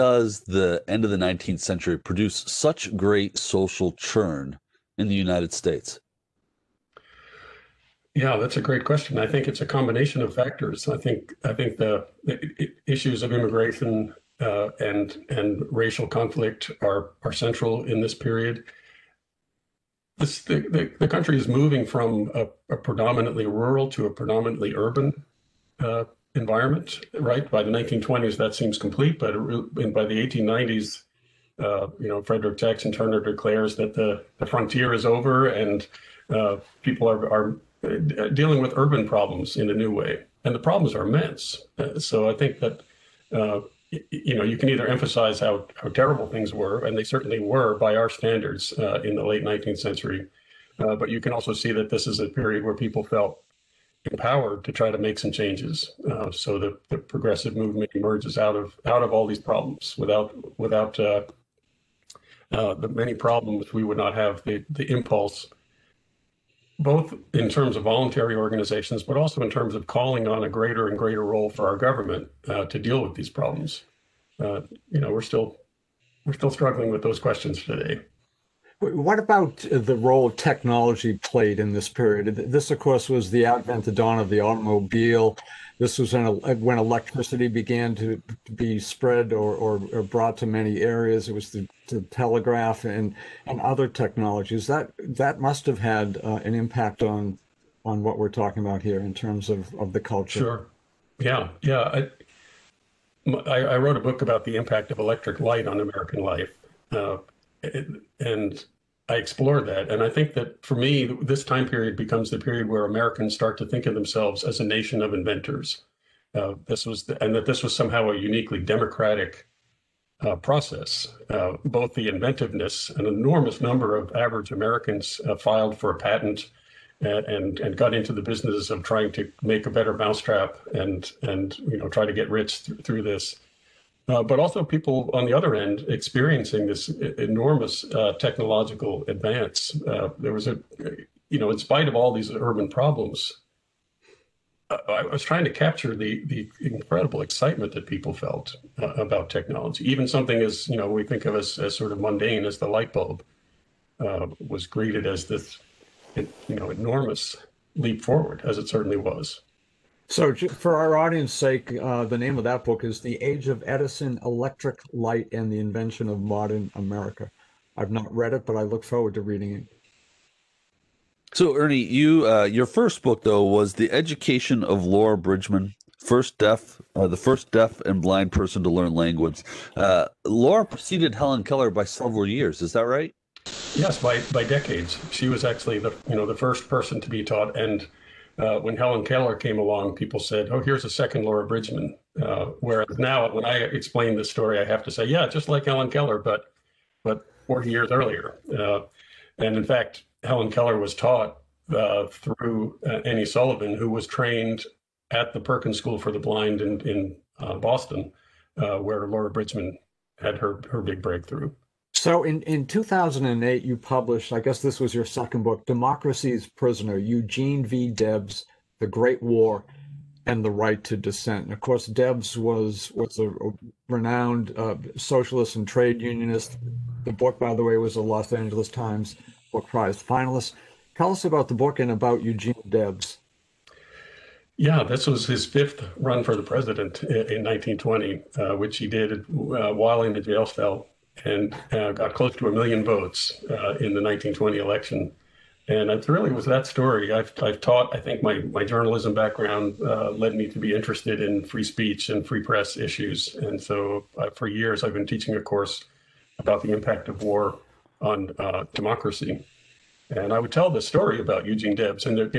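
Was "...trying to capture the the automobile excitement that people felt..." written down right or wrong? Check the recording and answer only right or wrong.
wrong.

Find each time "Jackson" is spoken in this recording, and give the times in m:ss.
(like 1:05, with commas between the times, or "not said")
0:32.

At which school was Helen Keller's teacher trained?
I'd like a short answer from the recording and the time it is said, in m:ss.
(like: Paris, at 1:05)
Perkins School for the Blind, at 3:25.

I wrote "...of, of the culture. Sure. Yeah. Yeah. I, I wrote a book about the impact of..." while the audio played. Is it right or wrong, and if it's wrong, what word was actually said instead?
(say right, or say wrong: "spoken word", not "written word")
right.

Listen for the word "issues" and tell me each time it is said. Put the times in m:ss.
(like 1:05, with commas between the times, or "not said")
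0:12, 4:12.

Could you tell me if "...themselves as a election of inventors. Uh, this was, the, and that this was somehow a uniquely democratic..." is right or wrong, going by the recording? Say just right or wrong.
wrong.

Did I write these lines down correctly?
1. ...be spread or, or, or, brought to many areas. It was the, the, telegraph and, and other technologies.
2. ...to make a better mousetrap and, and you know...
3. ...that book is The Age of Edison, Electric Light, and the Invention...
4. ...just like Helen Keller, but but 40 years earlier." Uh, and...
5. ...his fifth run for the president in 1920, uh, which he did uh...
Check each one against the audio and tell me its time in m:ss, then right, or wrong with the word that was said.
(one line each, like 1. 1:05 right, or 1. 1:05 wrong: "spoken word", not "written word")
1. 1:28 right
2. 2:09 right
3. 2:42 right
4. 3:15 right
5. 3:55 right.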